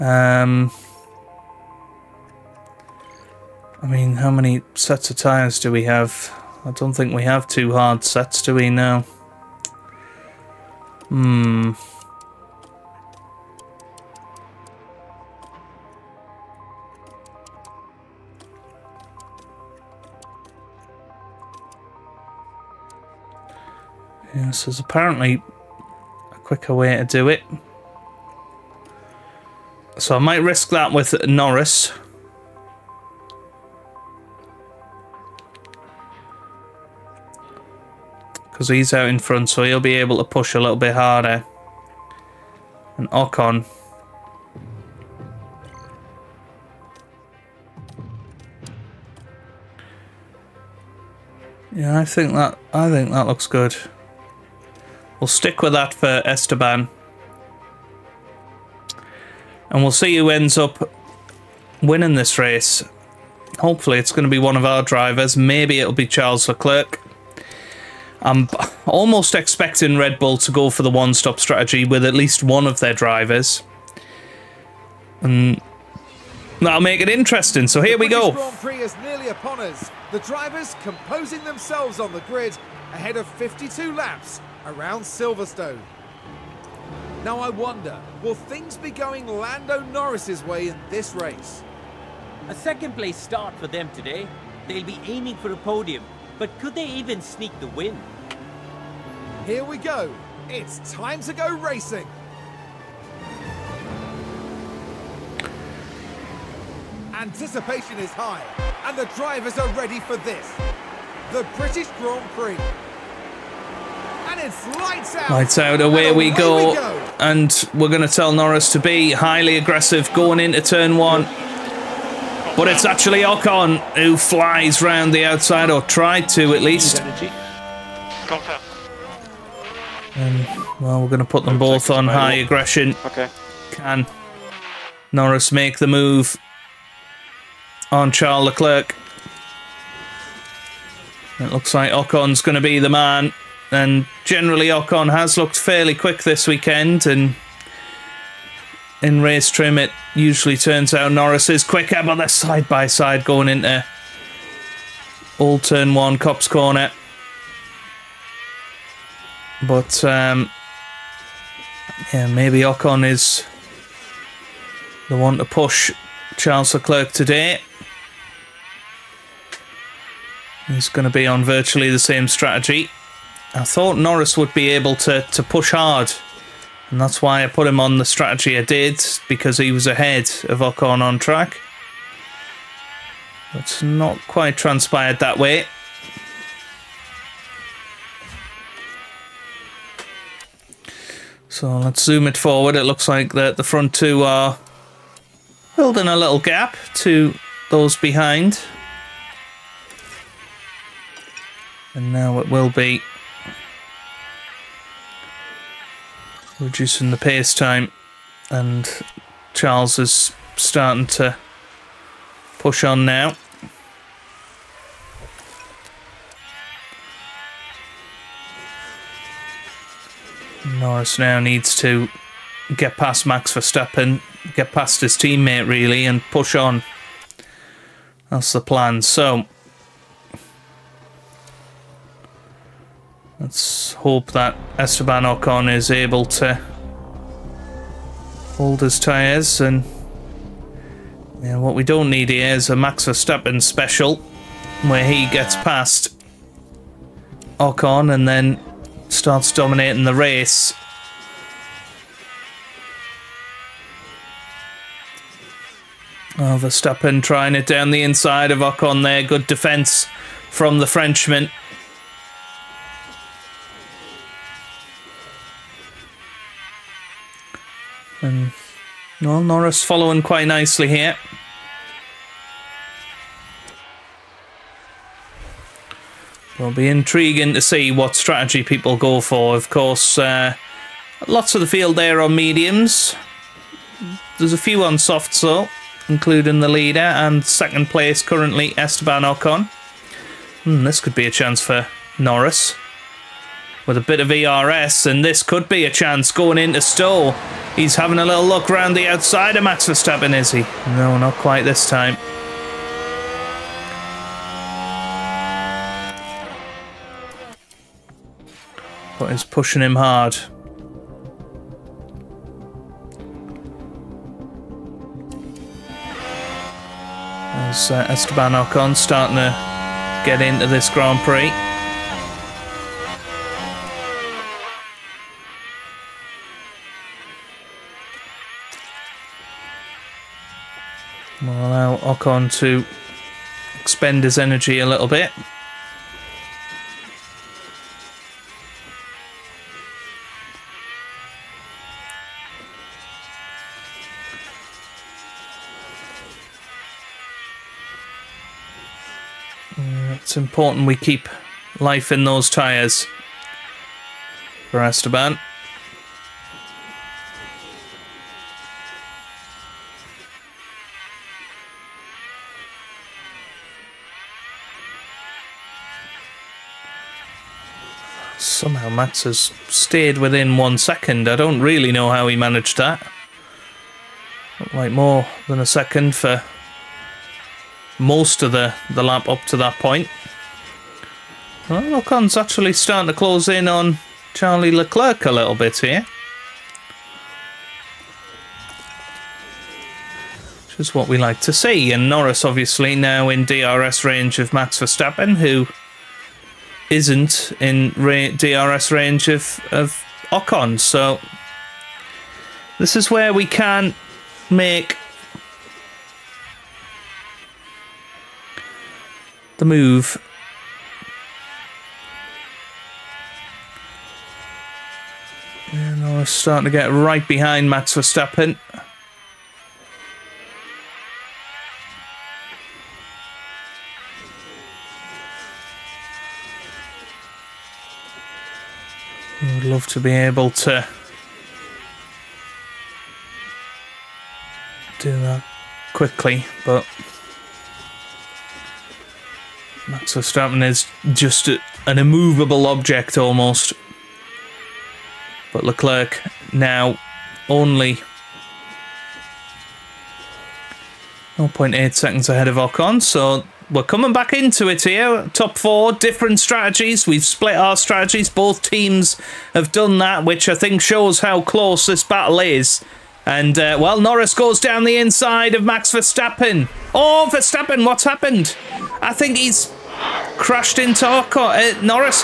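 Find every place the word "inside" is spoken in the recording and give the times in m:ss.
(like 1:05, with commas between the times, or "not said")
4:18, 7:44.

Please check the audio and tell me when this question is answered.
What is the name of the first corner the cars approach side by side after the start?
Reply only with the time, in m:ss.
2:36.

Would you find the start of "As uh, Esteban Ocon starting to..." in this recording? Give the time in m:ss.
5:17.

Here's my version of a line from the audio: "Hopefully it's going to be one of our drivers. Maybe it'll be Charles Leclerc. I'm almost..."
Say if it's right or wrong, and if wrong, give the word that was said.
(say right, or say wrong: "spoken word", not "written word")
right.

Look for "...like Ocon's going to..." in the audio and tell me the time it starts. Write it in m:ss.
2:21.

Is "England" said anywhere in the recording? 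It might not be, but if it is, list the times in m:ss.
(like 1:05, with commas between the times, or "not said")
not said.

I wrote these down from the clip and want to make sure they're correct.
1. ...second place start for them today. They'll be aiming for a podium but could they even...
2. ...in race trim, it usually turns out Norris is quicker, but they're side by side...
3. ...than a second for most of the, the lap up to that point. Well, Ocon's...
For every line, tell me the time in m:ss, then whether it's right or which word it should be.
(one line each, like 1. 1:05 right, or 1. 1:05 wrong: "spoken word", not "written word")
1. 1:32 right
2. 2:29 right
3. 6:15 right.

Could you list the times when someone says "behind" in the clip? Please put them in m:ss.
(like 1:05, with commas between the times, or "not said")
3:17, 6:57.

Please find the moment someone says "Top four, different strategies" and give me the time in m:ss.
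7:35.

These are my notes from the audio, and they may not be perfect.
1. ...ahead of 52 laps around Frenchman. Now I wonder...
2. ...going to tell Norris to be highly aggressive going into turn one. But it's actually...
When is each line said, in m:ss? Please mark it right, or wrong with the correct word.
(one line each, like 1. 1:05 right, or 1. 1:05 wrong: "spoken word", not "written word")
1. 1:22 wrong: "Silverstone", not "Frenchman"
2. 1:57 right.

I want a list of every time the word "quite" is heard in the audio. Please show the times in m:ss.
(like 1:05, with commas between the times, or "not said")
3:04, 4:30, 5:01.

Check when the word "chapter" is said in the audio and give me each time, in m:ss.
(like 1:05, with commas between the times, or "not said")
not said.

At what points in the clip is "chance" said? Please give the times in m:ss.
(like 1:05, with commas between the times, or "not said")
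4:51, 4:55.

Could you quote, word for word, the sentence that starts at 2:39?
But, um, yeah, maybe Ocon is the one to push Charles Leclerc today.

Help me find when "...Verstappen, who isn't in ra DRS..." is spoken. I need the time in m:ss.
6:34.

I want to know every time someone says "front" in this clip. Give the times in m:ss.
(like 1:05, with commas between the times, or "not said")
0:39, 3:13.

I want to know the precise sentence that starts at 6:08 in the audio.
Somehow Max has stayed within one second.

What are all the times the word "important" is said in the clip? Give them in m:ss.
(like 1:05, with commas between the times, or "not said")
5:50.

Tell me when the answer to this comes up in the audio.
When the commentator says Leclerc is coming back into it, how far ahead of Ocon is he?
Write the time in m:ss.
7:31.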